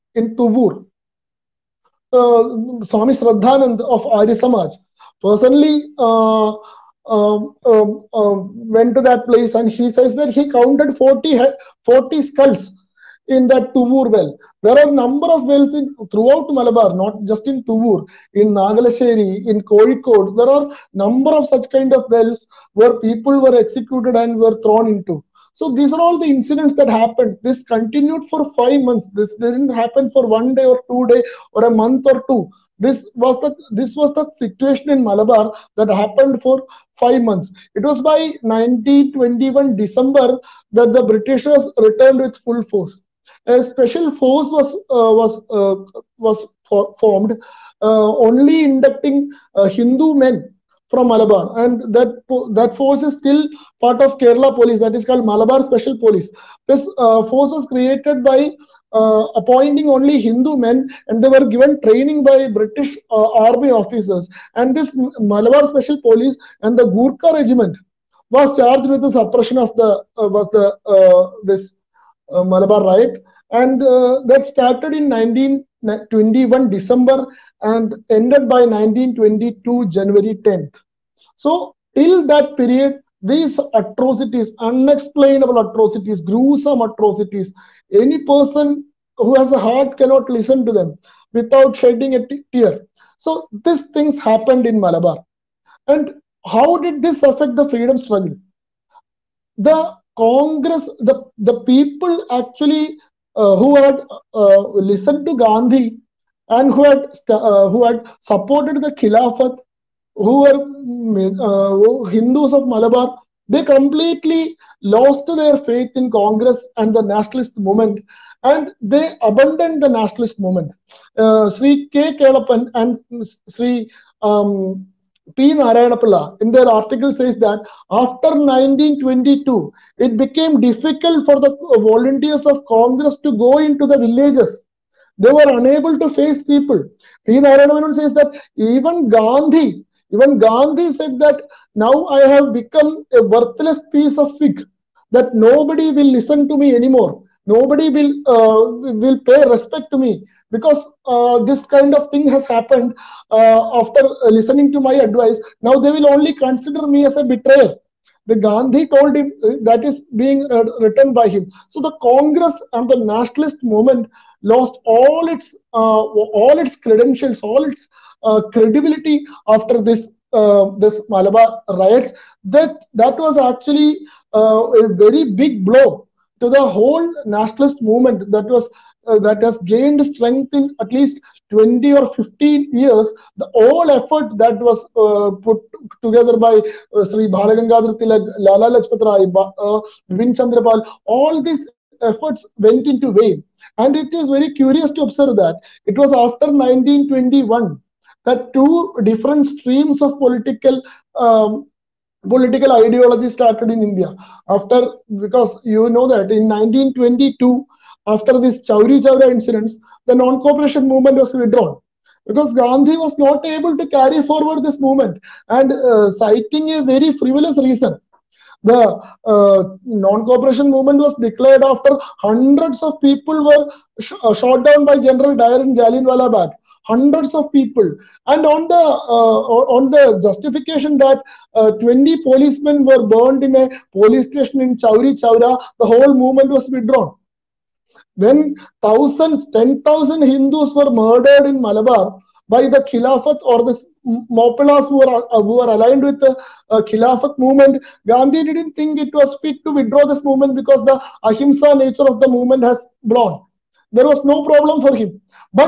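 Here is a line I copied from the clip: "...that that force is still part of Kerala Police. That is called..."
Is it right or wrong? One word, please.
right.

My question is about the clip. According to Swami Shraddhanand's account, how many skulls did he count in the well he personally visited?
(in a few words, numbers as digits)
40.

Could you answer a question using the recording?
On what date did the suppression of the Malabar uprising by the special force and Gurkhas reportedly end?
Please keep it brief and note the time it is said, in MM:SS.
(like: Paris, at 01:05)
1922 January 10, at 01:18.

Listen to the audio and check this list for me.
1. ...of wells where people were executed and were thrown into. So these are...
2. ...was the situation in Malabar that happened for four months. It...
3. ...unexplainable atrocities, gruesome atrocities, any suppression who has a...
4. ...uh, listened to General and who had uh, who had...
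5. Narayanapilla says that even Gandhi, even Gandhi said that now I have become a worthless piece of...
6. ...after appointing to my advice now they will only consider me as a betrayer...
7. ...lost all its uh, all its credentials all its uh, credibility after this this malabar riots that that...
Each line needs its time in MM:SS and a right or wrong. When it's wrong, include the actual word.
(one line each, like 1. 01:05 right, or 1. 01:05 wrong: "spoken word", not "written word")
1. 00:21 right
2. 00:33 wrong: "five", not "four"
3. 01:24 wrong: "person", not "suppression"
4. 01:44 wrong: "Gandhi", not "General"
5. 02:17 right
6. 02:33 wrong: "listening", not "appointing"
7. 02:44 right.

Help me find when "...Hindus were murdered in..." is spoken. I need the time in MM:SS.
04:00.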